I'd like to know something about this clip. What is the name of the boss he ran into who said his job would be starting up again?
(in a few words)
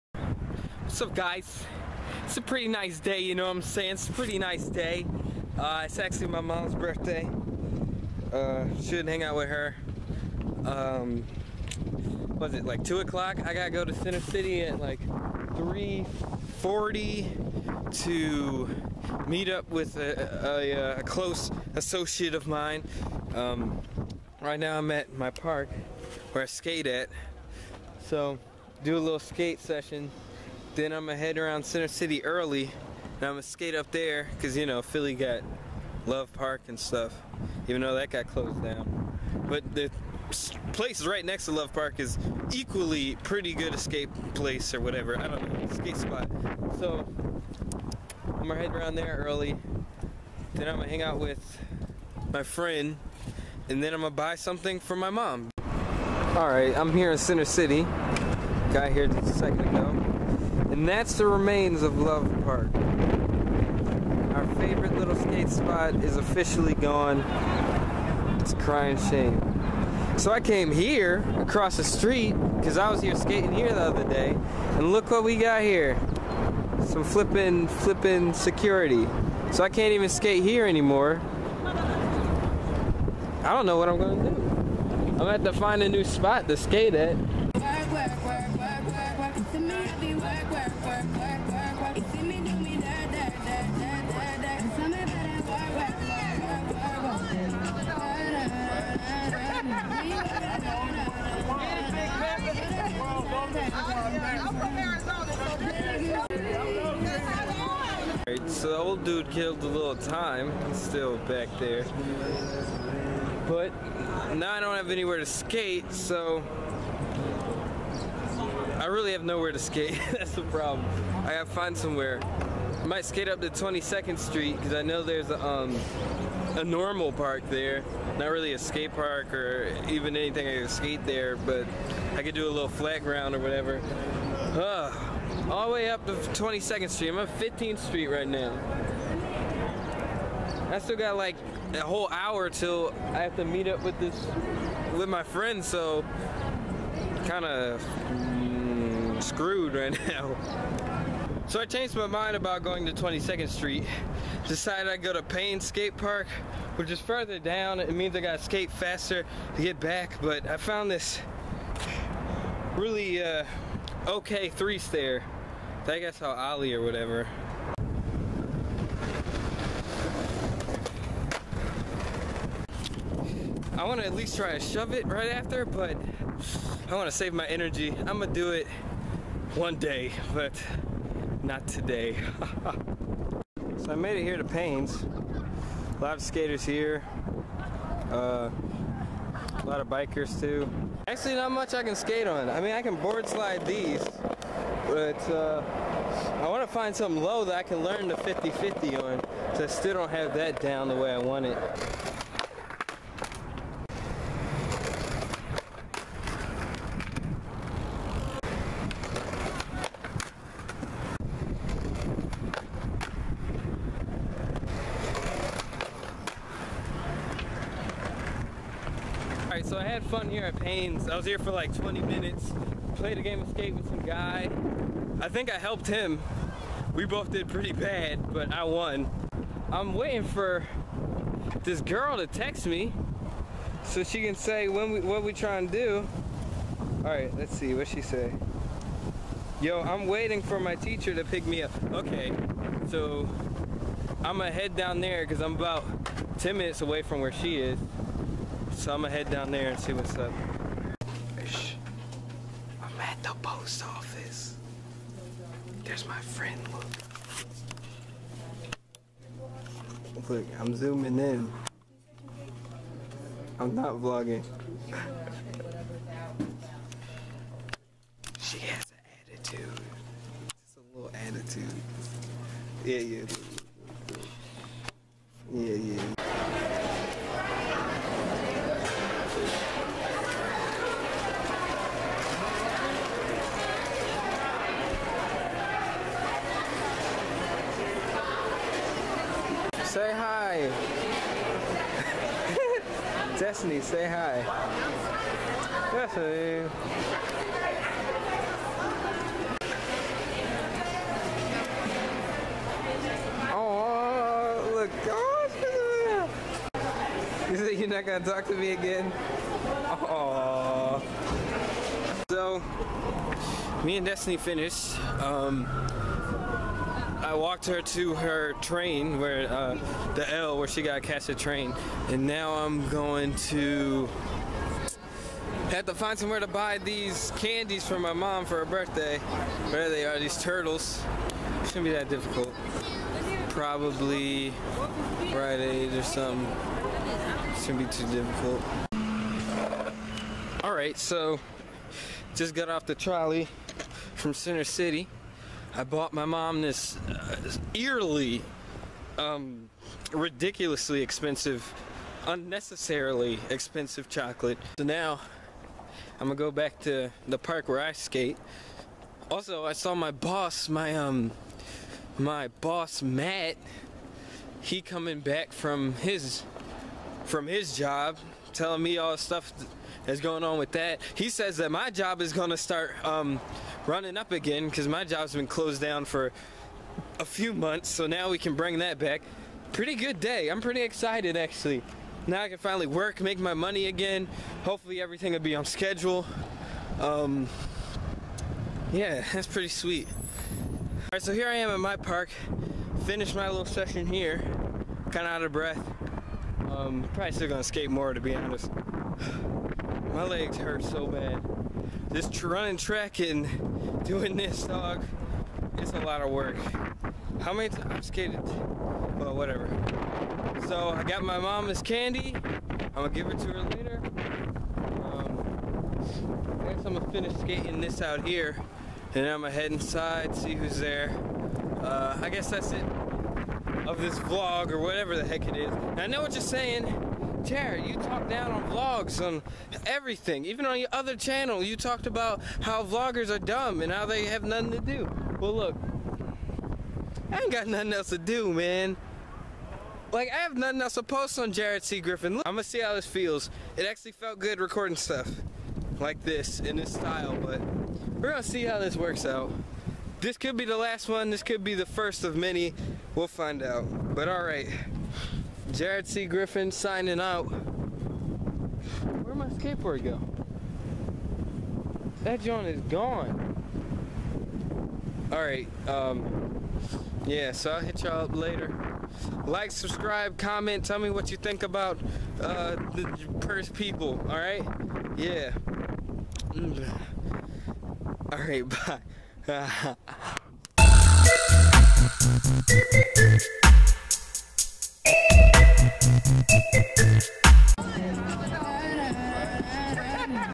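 Matt.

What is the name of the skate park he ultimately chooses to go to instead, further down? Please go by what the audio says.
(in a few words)
Paine Skate Park.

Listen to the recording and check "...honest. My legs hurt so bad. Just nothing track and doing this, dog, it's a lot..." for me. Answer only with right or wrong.
wrong.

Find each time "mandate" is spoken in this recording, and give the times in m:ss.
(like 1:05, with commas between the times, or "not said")
not said.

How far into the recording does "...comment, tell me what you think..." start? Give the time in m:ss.
7:50.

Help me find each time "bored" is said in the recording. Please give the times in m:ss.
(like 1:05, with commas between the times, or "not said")
not said.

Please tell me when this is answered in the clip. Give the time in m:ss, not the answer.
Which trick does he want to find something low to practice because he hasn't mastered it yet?
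3:18.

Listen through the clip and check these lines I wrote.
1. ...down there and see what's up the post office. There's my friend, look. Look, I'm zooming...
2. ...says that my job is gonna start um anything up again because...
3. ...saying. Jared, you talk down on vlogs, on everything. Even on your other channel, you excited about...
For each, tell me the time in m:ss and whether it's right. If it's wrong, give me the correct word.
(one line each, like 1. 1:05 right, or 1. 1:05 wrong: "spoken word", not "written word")
1. 4:09 right
2. 6:11 wrong: "running", not "anything"
3. 7:06 wrong: "talked", not "excited".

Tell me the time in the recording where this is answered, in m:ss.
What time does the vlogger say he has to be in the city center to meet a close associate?
0:15.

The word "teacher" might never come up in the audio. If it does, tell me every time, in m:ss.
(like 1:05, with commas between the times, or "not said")
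4:00.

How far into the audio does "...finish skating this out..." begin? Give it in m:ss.
6:57.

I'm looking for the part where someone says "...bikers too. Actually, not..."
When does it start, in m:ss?
3:09.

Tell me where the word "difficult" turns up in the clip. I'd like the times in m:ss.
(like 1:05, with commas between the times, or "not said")
5:32, 5:38.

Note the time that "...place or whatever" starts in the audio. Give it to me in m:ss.
0:44.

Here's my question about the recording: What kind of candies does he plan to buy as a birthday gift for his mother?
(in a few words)
Turtles.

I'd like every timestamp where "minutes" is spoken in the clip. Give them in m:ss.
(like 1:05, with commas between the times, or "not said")
3:42, 4:06.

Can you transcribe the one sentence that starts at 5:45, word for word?
I bought my mom this uh, eerily, um, ridiculously expensive, unnecessarily expensive chocolate.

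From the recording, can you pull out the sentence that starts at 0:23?
Um, right now I'm at my park where I skate at.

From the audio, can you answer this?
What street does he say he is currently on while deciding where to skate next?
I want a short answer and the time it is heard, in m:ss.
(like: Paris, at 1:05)
15th Street, at 2:17.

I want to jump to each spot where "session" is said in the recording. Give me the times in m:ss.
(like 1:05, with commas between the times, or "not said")
0:29, 6:33.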